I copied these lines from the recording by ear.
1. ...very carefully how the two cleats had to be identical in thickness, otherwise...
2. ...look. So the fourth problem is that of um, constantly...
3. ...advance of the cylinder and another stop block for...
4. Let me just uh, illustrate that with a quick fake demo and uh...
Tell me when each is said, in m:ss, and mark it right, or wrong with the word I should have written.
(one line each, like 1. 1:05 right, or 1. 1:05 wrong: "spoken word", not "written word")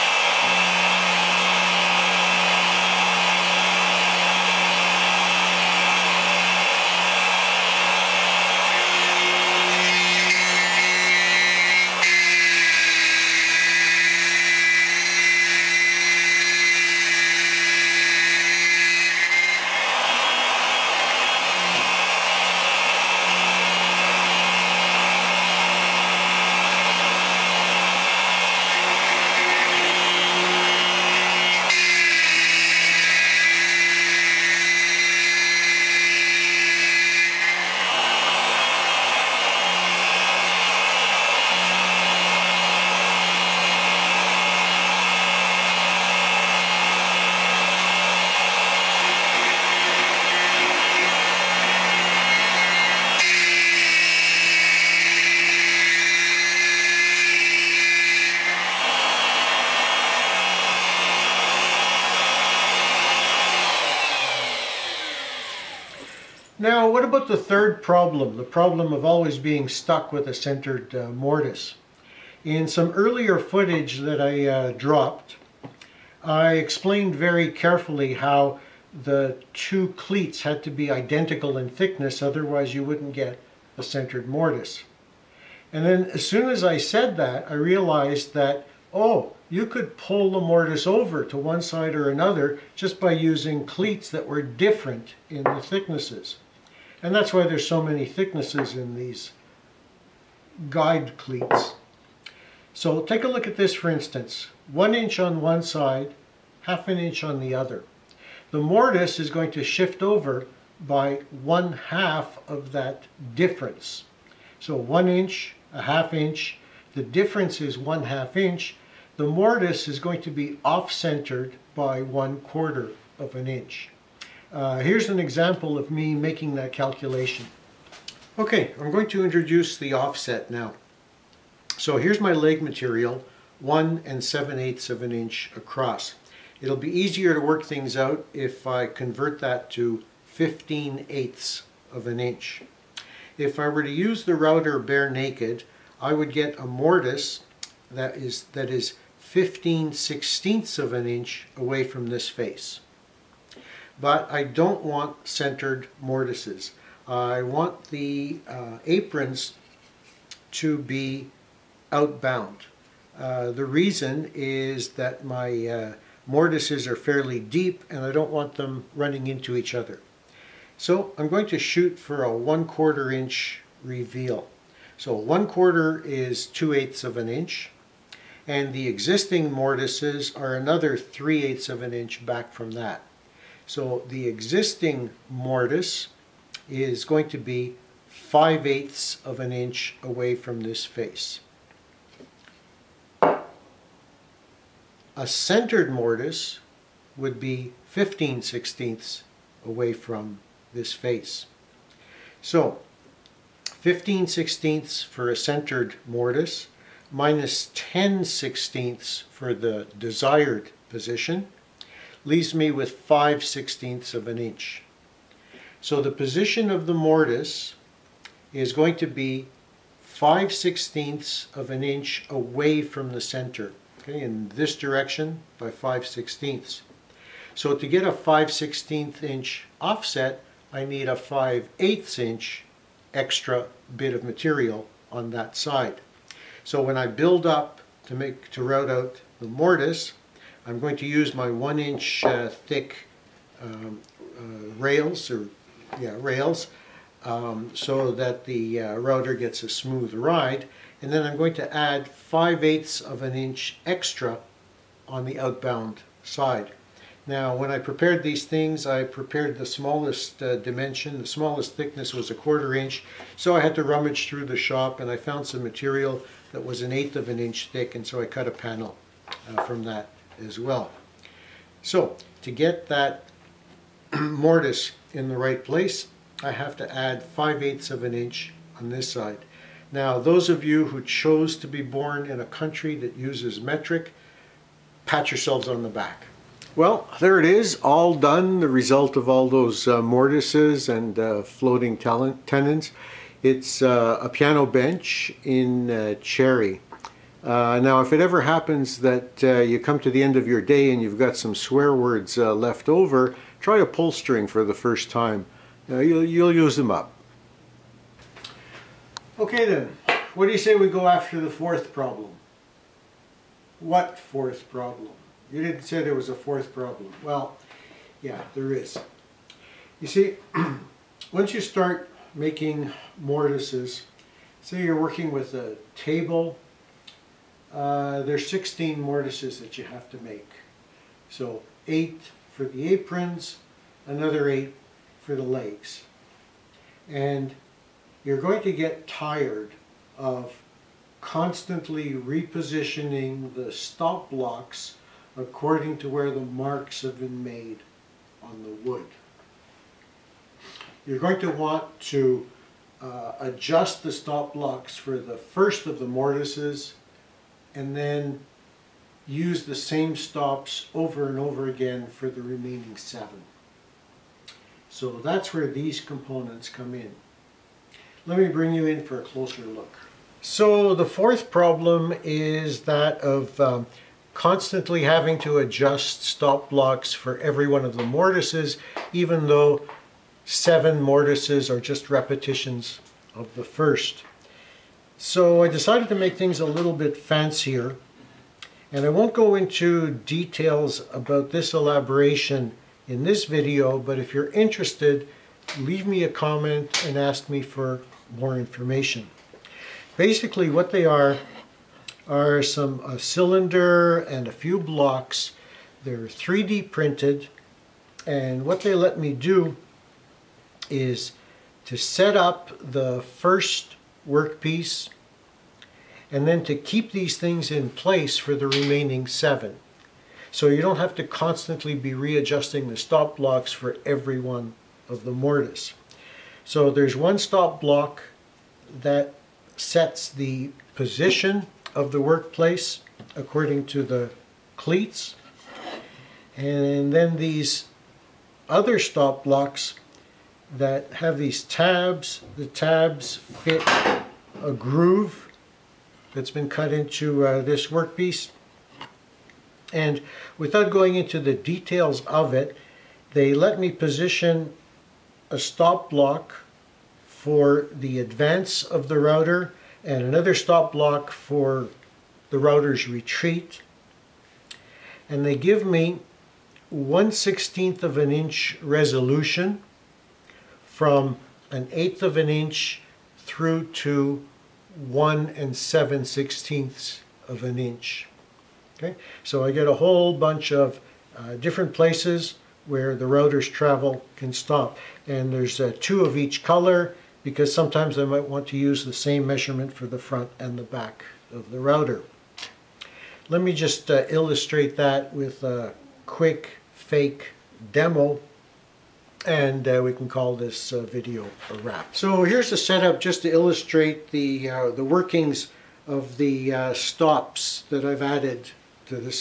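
1. 1:17 right
2. 6:09 right
3. 7:38 wrong: "router", not "cylinder"
4. 8:13 right.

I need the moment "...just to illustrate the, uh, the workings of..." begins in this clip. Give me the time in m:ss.
8:23.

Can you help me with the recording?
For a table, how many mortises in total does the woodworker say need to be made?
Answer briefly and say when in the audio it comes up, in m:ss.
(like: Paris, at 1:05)
16, at 5:28.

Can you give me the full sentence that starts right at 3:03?
So the existing mortise is going to be 5 eighths of an inch away from this face.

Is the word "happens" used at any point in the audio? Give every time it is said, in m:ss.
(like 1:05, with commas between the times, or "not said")
4:58.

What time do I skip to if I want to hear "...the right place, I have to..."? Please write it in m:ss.
4:35.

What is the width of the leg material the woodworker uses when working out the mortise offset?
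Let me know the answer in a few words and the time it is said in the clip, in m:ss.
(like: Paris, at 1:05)
1 7/8 inches, at 2:13.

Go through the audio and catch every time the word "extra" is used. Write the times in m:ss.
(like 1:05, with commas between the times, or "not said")
3:53, 4:13.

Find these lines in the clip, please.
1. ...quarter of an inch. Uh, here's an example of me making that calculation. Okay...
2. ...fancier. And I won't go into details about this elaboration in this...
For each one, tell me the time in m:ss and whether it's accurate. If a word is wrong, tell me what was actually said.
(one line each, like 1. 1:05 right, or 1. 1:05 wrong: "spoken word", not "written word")
1. 2:02 right
2. 6:27 right.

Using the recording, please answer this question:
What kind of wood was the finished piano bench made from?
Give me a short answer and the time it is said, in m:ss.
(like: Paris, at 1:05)
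Cherry, at 4:56.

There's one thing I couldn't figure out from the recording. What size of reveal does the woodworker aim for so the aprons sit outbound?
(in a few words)
1/4 inch.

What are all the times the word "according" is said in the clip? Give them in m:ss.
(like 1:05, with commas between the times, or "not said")
5:45, 7:13.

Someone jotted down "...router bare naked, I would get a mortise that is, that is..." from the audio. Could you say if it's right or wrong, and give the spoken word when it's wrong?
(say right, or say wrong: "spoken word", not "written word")
right.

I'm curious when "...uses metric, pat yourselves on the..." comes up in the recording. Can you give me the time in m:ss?
4:43.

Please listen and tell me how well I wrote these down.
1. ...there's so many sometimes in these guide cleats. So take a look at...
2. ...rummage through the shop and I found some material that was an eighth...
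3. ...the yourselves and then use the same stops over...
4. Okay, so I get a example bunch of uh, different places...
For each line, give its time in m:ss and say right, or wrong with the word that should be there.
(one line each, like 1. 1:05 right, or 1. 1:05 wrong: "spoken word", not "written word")
1. 1:37 wrong: "thicknesses", not "sometimes"
2. 4:23 right
3. 5:55 wrong: "mortises", not "yourselves"
4. 7:58 wrong: "whole", not "example".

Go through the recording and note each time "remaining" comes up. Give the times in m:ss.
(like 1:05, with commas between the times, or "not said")
6:02, 6:58.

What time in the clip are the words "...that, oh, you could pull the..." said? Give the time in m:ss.
1:28.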